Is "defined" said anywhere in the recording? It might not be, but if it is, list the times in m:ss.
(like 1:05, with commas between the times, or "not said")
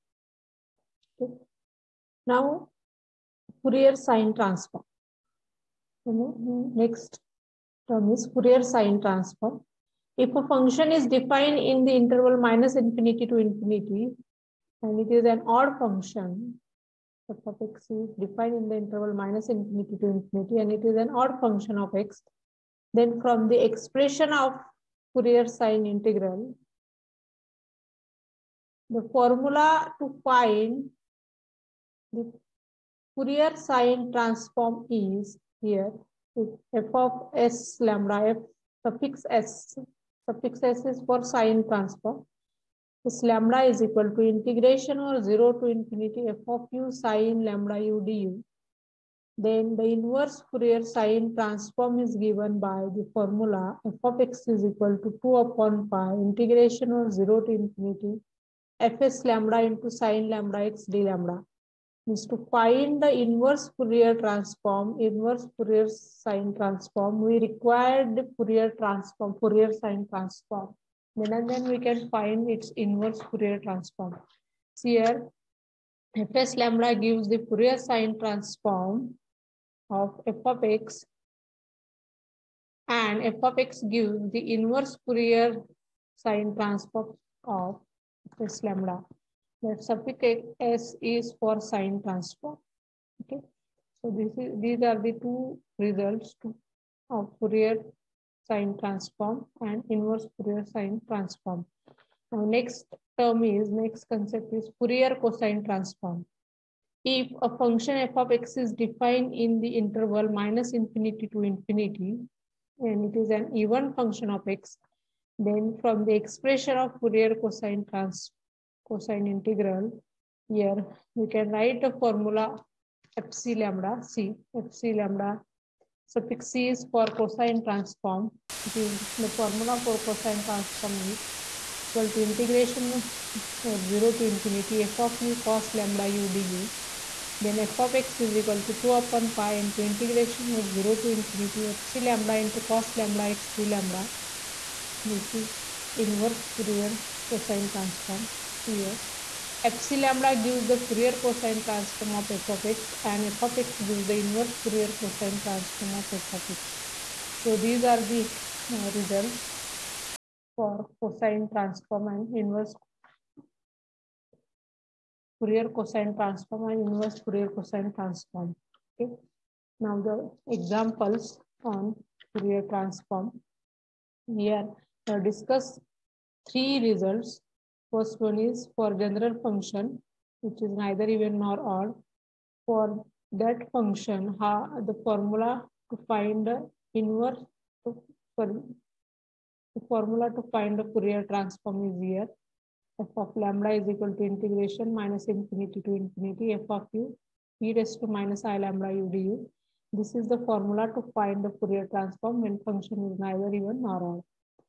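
0:11, 0:18, 1:48.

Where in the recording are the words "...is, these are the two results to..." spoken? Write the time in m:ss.
1:34.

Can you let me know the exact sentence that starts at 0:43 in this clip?
This lambda is equal to integration or 0 to infinity f of u sine lambda u du.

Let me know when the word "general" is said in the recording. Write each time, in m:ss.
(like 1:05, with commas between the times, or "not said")
2:58.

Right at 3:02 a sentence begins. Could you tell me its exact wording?
For that function, how the formula to find the inverse, the formula to find the Fourier transform is here.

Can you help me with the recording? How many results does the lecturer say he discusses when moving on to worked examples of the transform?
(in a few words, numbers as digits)
3.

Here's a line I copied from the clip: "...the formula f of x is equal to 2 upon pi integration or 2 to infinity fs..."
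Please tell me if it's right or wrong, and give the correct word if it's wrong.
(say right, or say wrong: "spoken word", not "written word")
wrong: "0", not "2".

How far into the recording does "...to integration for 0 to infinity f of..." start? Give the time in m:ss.
2:12.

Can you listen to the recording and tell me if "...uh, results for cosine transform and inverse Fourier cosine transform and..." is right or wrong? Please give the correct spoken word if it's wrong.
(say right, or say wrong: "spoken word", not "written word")
right.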